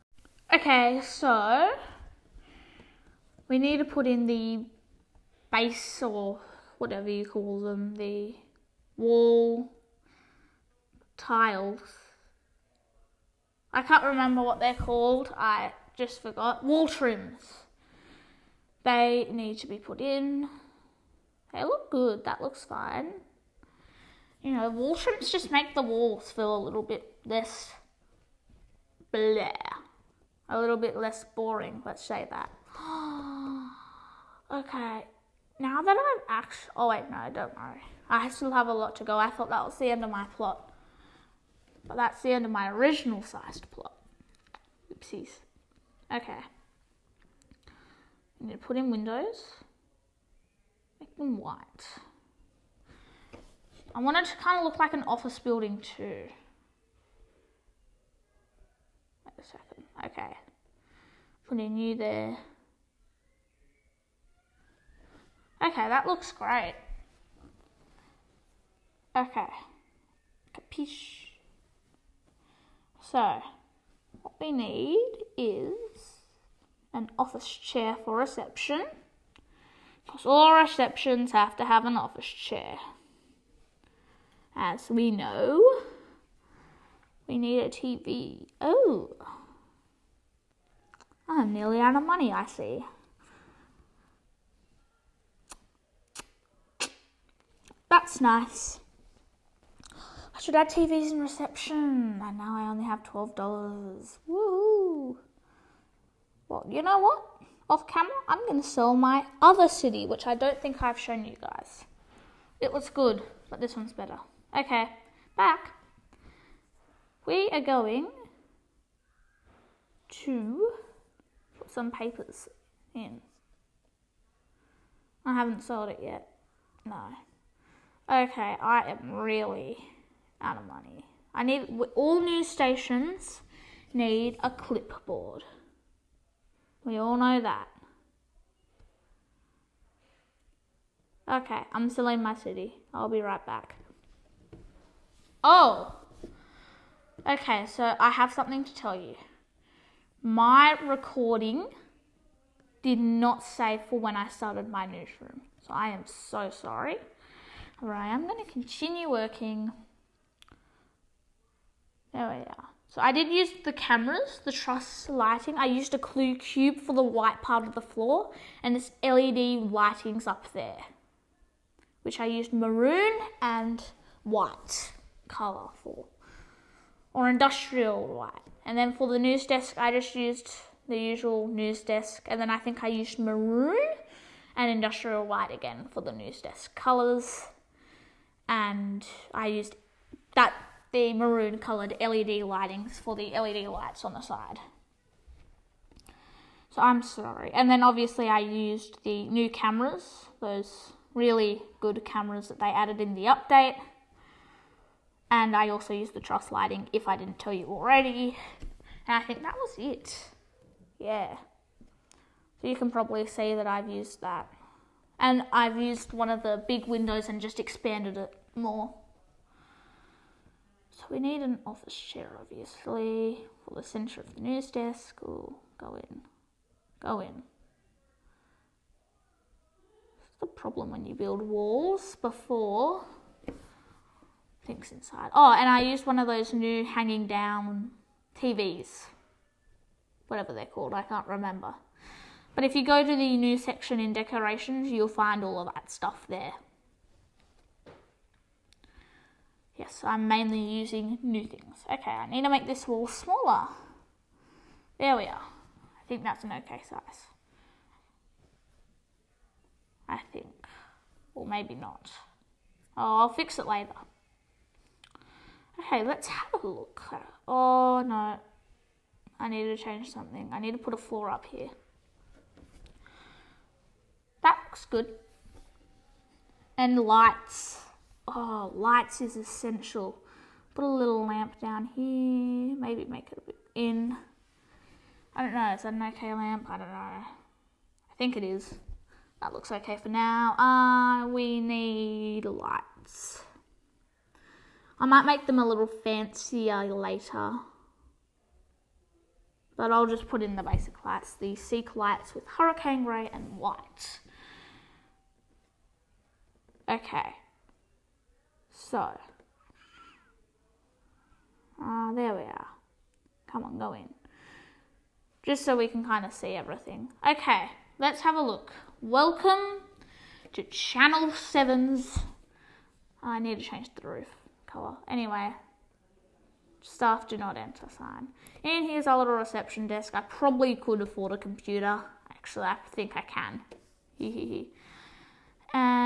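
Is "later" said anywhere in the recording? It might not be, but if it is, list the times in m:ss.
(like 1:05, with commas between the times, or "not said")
4:23, 4:56.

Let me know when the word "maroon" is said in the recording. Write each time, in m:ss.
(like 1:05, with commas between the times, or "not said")
2:52, 3:03, 3:11.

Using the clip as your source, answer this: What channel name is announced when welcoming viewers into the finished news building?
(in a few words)
Channel 7.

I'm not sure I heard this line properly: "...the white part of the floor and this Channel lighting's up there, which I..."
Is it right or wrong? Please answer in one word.
wrong.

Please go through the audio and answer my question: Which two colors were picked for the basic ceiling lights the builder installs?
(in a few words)
hurricane grey and white.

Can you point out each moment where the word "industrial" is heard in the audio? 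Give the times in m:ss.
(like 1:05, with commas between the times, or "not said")
2:57, 3:04.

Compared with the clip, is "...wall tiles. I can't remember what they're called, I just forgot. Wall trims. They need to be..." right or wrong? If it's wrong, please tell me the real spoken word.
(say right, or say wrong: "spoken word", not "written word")
right.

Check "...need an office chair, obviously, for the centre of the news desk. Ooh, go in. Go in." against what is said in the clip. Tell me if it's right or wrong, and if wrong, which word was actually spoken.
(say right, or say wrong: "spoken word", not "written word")
right.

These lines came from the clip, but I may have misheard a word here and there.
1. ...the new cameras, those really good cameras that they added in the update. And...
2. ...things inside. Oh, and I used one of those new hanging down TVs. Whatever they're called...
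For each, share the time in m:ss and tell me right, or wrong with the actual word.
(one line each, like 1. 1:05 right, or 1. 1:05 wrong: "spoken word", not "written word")
1. 3:19 right
2. 3:54 right.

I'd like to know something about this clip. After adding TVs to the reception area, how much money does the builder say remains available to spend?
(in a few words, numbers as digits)
$12.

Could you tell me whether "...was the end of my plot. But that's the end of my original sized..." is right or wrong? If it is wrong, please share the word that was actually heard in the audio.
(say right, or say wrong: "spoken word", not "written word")
right.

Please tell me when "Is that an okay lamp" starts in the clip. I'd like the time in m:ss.
4:45.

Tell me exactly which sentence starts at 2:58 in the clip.
And then for the news desk, I just used the usual news desk.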